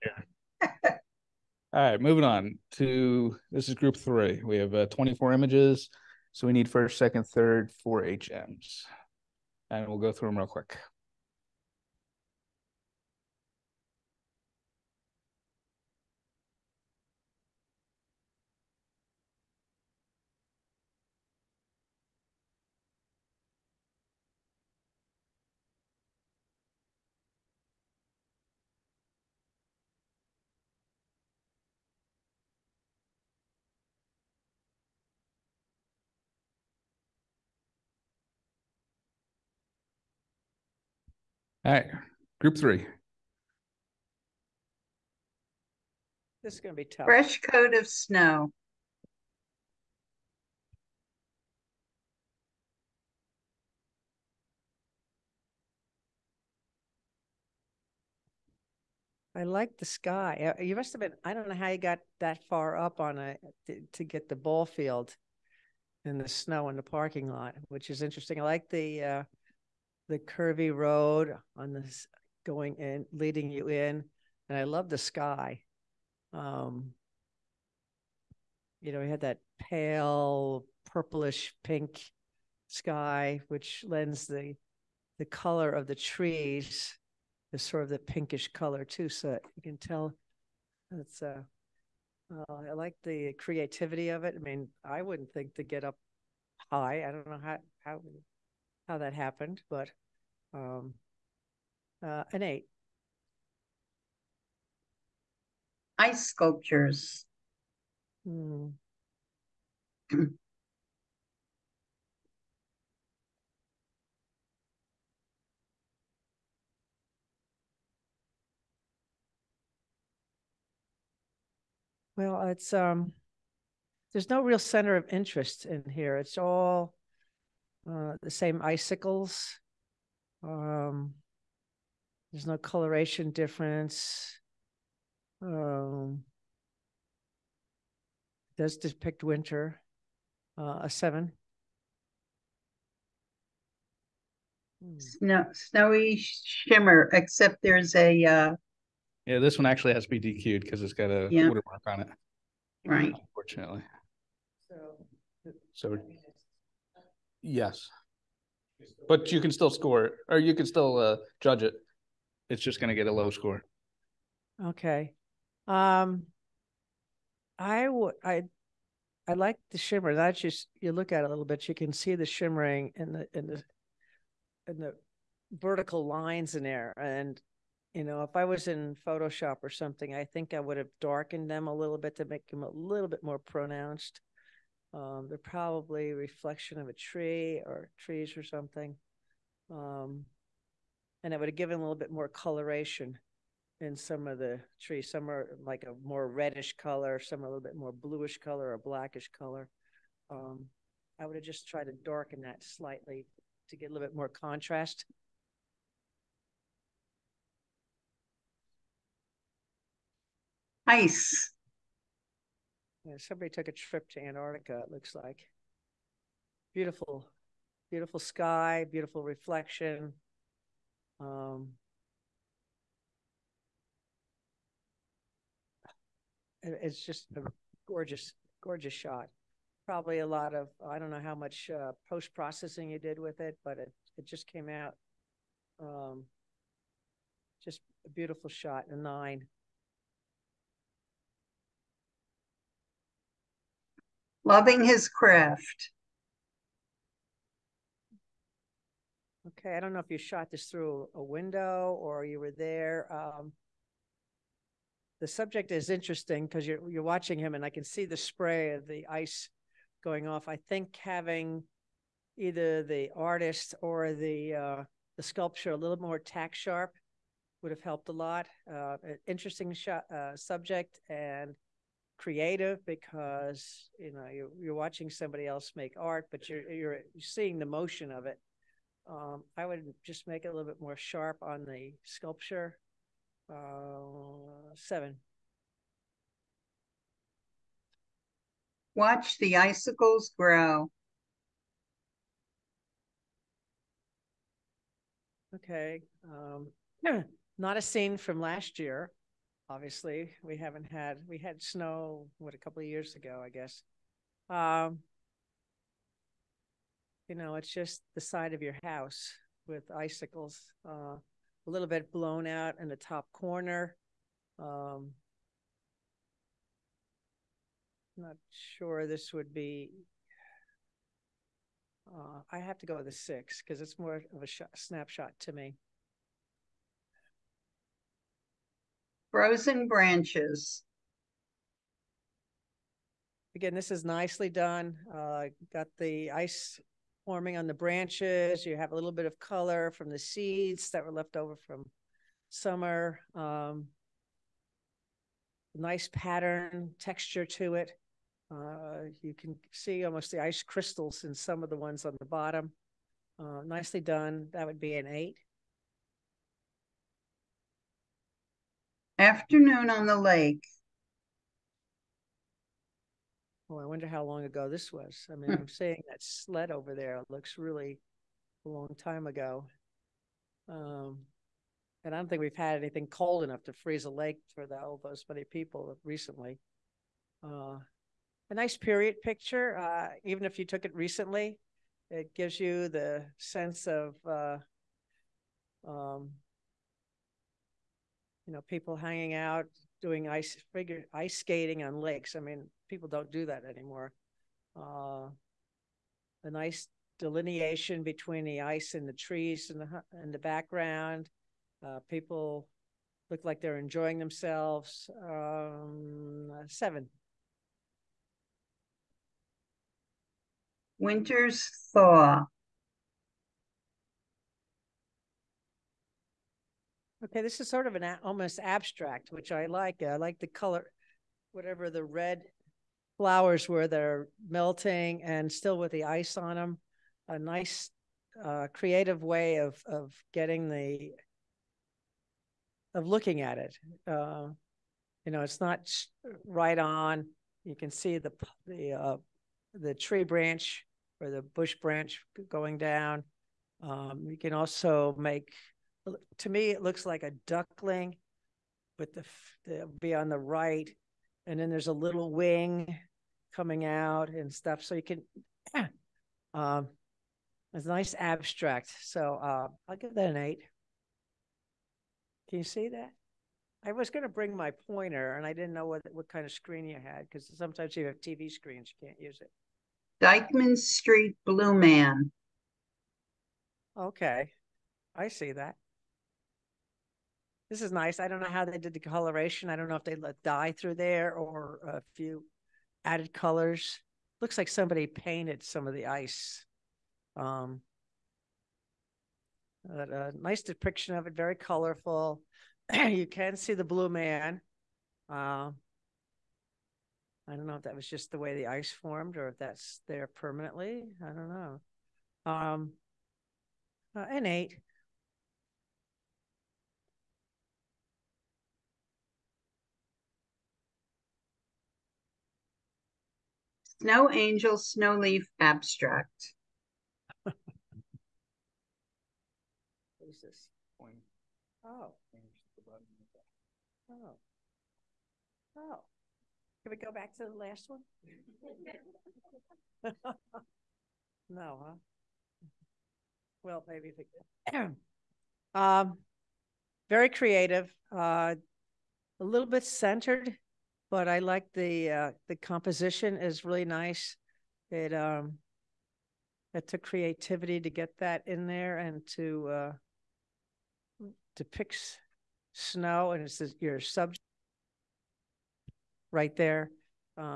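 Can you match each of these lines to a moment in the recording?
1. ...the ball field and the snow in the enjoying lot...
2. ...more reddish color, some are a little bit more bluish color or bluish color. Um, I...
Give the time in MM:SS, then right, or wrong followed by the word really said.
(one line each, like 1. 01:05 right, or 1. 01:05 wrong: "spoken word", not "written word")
1. 01:04 wrong: "parking", not "enjoying"
2. 03:16 wrong: "blackish", not "bluish".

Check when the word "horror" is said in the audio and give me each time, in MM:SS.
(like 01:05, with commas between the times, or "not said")
not said.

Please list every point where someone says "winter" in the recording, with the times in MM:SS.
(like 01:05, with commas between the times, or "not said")
02:19, 06:50.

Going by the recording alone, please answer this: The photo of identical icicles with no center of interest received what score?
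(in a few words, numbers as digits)
7.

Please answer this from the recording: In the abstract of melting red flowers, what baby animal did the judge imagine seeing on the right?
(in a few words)
A duckling.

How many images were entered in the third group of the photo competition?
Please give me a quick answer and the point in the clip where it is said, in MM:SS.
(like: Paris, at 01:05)
24, at 00:04.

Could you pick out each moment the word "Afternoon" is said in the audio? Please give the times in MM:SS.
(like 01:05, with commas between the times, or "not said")
05:59.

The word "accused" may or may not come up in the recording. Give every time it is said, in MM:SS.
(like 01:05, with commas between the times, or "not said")
not said.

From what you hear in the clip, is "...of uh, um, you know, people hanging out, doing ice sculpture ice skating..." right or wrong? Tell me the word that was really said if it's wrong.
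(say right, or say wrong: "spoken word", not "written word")
wrong: "figure", not "sculpture".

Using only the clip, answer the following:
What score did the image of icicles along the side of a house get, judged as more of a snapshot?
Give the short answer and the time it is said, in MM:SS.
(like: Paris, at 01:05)
6, at 05:23.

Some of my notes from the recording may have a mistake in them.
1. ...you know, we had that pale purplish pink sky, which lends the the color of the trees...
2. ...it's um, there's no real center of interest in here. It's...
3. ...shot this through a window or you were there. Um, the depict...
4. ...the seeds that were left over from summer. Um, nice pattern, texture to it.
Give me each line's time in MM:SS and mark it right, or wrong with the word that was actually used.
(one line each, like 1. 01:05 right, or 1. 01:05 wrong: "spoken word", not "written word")
1. 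01:18 right
2. 02:02 right
3. 04:10 wrong: "subject", not "depict"
4. 05:40 right.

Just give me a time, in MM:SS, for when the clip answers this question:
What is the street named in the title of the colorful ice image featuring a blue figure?
07:50.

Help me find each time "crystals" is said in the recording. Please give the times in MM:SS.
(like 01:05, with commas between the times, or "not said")
05:50.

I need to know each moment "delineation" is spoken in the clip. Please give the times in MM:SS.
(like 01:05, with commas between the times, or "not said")
06:37.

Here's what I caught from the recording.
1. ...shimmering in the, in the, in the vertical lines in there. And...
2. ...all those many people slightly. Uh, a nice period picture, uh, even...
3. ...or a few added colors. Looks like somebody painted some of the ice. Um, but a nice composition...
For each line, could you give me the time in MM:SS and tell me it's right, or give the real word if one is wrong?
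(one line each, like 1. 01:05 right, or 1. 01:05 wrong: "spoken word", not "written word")
1. 02:52 right
2. 06:14 wrong: "recently", not "slightly"
3. 08:01 wrong: "depiction", not "composition".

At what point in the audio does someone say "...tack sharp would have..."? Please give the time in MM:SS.
04:26.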